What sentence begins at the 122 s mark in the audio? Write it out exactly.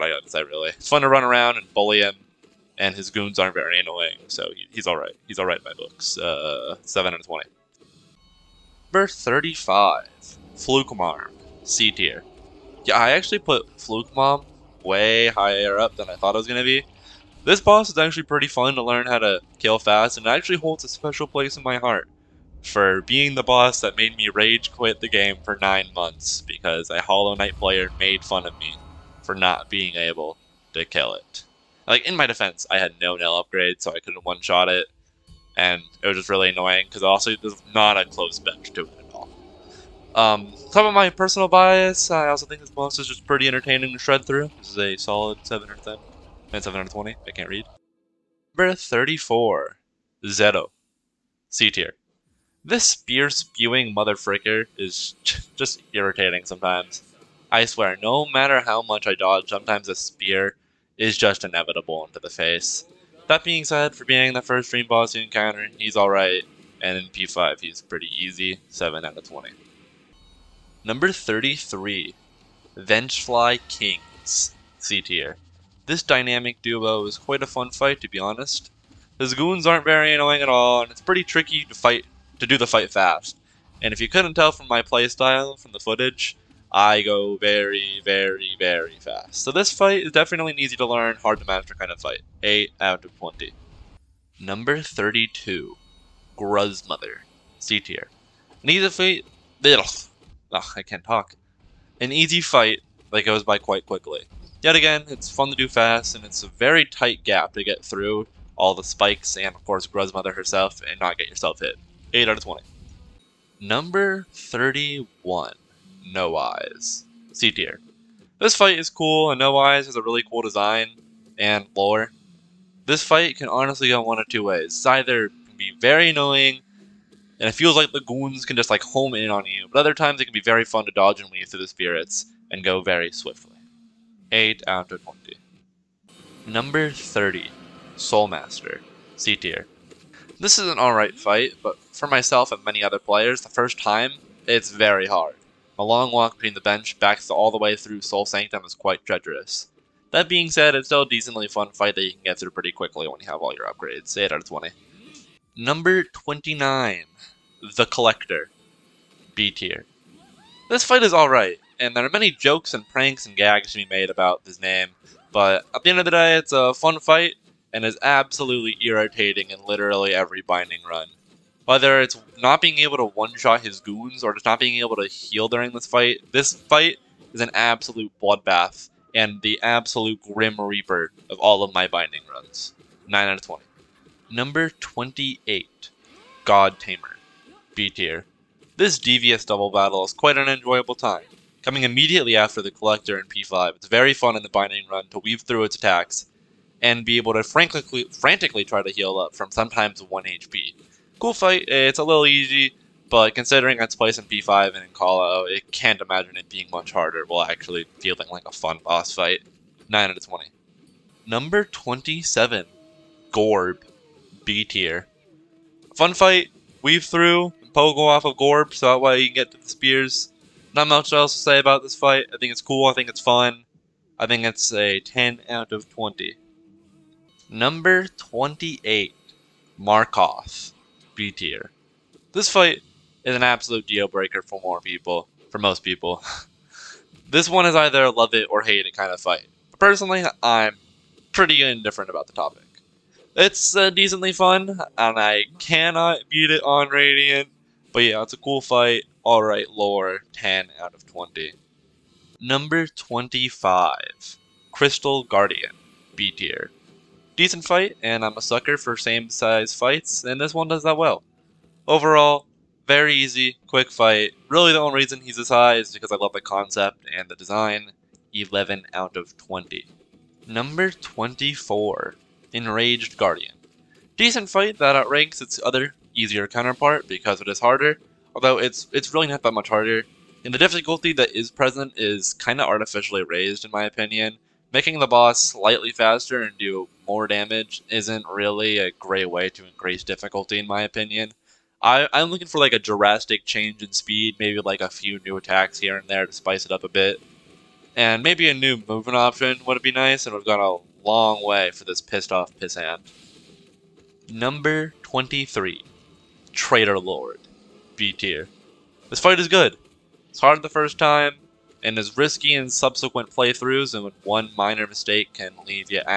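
This fight can honestly go one of two ways.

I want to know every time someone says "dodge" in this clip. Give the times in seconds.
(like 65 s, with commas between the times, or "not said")
59 s, 130 s.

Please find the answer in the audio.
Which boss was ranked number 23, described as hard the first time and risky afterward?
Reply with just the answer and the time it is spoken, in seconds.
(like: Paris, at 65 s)
Traitor Lord, at 306 s.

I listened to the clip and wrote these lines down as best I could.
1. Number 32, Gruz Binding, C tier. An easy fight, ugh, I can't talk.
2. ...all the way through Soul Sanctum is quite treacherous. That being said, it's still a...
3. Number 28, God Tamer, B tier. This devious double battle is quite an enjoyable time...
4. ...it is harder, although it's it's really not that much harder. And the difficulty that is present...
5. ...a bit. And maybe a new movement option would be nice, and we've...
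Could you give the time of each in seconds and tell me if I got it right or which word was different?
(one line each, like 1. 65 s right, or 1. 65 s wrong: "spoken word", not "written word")
1. 94 s wrong: "Mother", not "Binding"
2. 147 s right
3. 184 s right
4. 277 s right
5. 296 s right.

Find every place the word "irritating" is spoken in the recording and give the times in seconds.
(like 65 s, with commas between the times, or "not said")
55 s, 168 s.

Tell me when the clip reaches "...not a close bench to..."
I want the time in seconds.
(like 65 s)
37 s.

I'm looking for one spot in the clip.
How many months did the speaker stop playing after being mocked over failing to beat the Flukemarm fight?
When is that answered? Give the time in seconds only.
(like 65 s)
25 s.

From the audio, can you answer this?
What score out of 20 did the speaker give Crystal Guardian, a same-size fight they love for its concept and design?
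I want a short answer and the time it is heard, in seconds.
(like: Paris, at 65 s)
11, at 268 s.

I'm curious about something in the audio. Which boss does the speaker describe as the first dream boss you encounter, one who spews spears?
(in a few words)
Zote.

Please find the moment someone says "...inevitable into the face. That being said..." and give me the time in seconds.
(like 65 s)
61 s.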